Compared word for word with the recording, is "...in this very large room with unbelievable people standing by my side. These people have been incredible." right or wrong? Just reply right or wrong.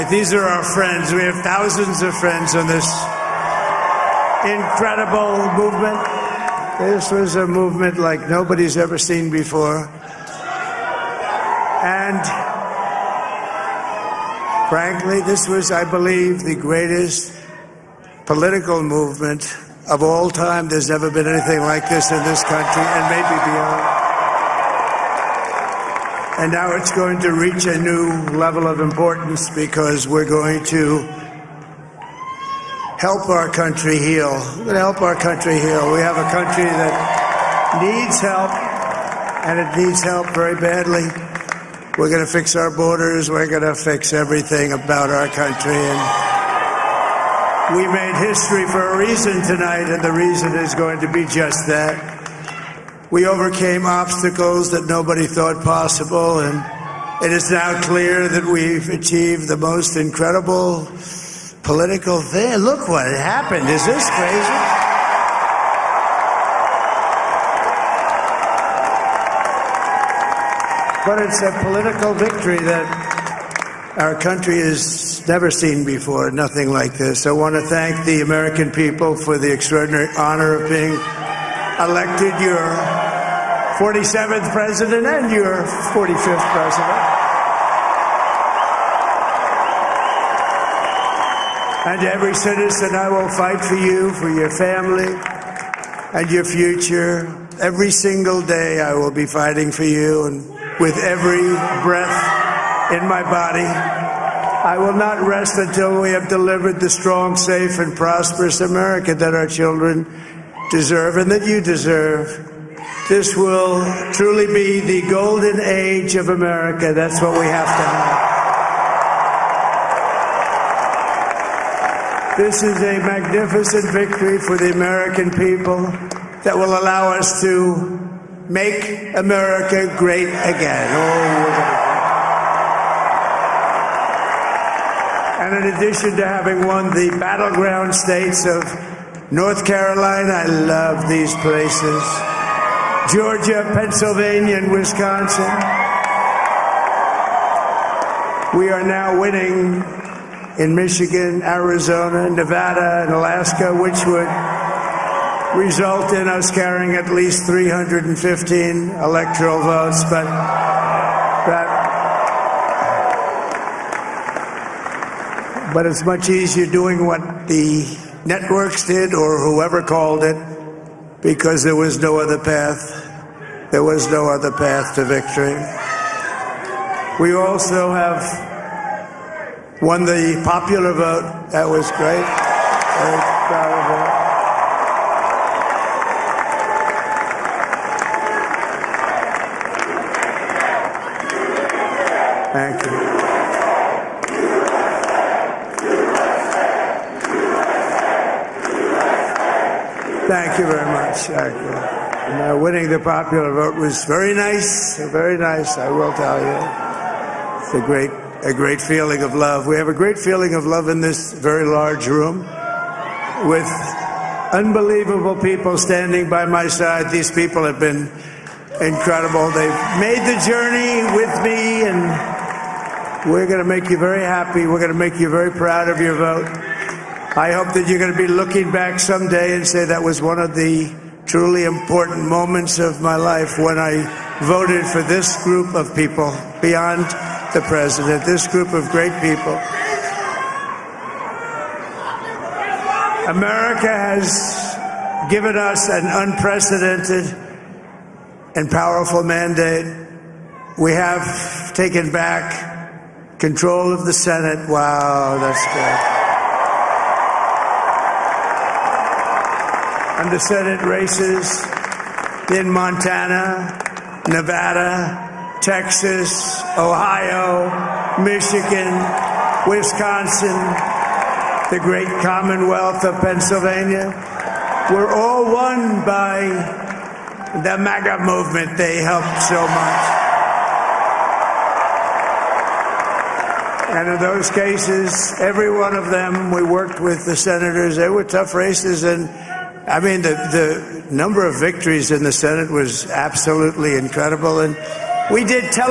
right.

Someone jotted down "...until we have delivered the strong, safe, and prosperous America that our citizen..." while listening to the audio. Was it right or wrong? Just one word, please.
wrong.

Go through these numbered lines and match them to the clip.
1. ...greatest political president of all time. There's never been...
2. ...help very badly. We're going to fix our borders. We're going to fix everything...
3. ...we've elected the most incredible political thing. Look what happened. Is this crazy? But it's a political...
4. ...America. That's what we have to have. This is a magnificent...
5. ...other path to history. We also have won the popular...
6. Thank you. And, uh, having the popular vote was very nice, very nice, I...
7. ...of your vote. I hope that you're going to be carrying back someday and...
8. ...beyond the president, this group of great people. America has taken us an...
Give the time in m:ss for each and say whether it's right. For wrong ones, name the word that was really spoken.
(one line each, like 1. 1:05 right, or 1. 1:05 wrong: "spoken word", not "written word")
1. 0:16 wrong: "movement", not "president"
2. 0:40 right
3. 0:58 wrong: "achieved", not "elected"
4. 1:56 right
5. 2:54 wrong: "victory", not "history"
6. 3:21 wrong: "winning", not "having"
7. 3:45 wrong: "looking", not "carrying"
8. 3:56 wrong: "given", not "taken".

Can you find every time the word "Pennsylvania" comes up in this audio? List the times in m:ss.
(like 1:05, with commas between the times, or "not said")
2:23, 4:33.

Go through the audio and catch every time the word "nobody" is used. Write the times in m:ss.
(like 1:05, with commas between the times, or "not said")
0:08, 0:54.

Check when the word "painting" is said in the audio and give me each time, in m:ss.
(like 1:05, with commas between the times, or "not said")
not said.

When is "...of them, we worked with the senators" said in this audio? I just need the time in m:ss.
4:45.